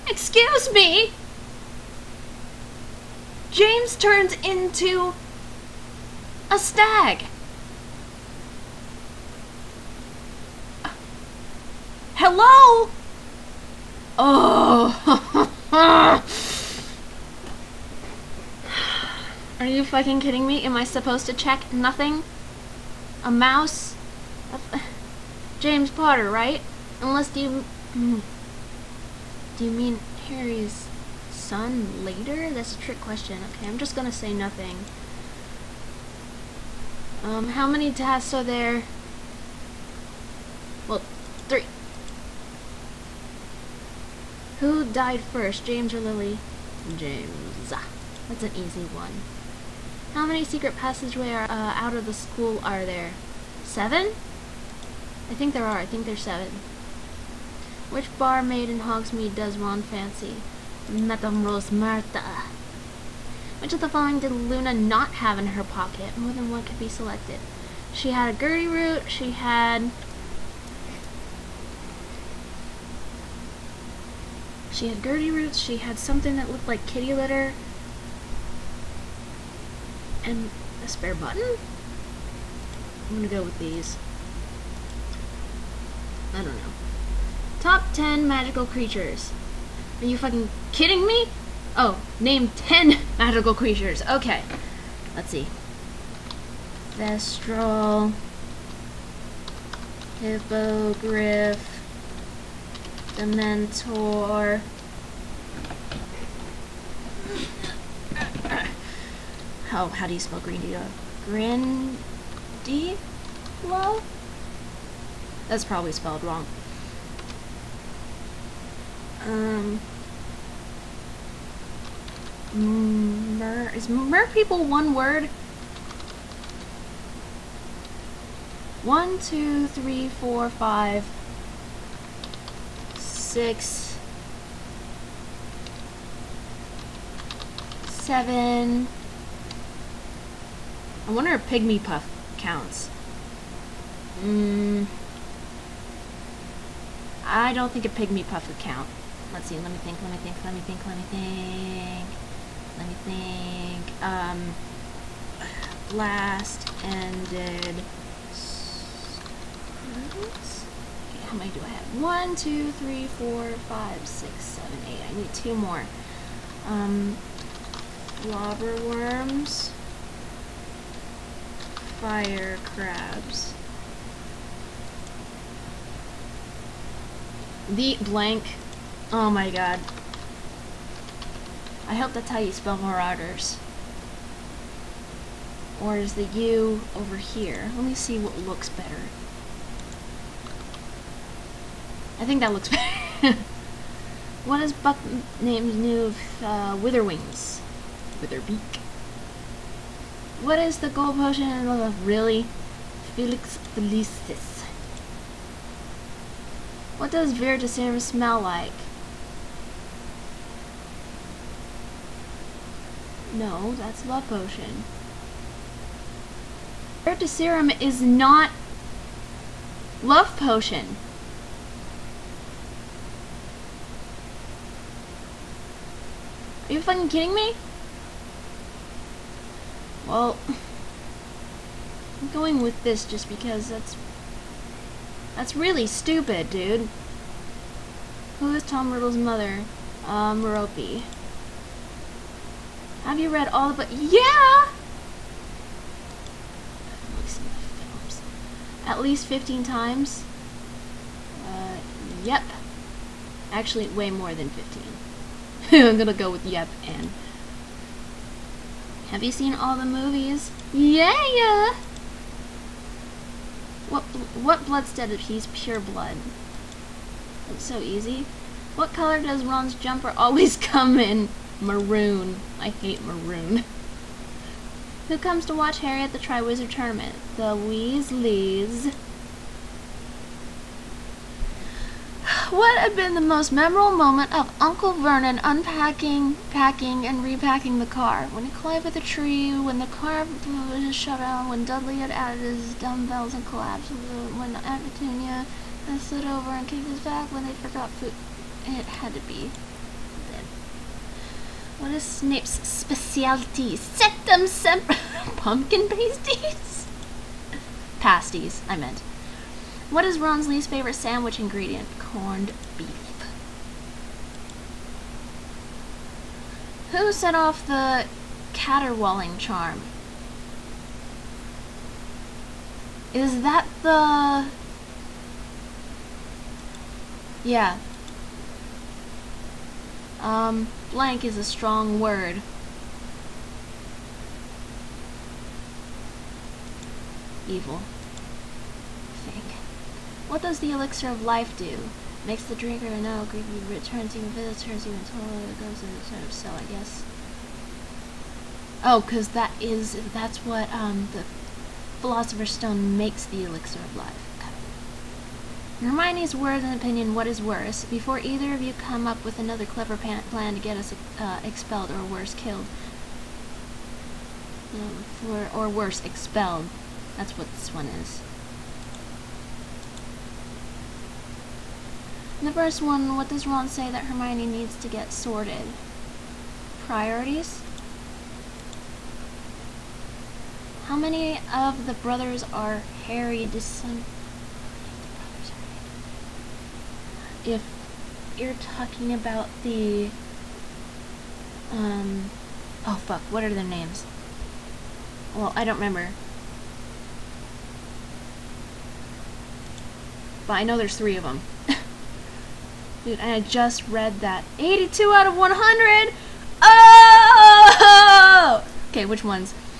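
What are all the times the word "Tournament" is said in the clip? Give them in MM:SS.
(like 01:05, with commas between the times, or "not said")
04:36.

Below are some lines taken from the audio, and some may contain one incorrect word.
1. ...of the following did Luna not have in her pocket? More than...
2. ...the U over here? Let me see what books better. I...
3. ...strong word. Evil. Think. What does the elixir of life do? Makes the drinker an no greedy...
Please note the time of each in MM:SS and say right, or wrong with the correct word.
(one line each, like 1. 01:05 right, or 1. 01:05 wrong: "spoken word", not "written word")
1. 01:03 right
2. 03:06 wrong: "looks", not "books"
3. 05:31 right.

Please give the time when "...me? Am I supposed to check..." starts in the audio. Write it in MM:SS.
00:20.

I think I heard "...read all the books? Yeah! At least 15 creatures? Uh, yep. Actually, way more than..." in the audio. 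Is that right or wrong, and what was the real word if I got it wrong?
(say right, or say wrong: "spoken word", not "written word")
wrong: "times", not "creatures".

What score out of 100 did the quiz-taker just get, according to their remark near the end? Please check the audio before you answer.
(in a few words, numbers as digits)
82.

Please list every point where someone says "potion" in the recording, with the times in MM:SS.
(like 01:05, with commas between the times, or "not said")
03:21, 03:34, 03:40.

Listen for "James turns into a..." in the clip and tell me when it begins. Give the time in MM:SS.
00:03.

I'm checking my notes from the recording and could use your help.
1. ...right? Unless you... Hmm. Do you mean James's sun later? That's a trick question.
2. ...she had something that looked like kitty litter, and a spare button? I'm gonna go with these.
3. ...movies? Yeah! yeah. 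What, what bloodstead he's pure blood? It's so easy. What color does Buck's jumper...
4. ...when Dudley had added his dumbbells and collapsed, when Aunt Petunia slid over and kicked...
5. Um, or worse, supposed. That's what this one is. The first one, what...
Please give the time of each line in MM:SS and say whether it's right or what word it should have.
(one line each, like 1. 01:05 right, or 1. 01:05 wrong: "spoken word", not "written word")
1. 00:26 wrong: "Harry", not "James"
2. 01:15 right
3. 04:19 wrong: "Ron", not "Buck"
4. 04:51 right
5. 06:04 wrong: "expelled", not "supposed".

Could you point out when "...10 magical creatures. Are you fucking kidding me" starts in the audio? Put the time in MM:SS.
01:27.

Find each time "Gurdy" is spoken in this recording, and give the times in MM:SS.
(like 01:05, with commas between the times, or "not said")
01:08, 01:15.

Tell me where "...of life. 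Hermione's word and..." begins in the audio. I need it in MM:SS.
05:53.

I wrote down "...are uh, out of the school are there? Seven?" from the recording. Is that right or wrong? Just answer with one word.
right.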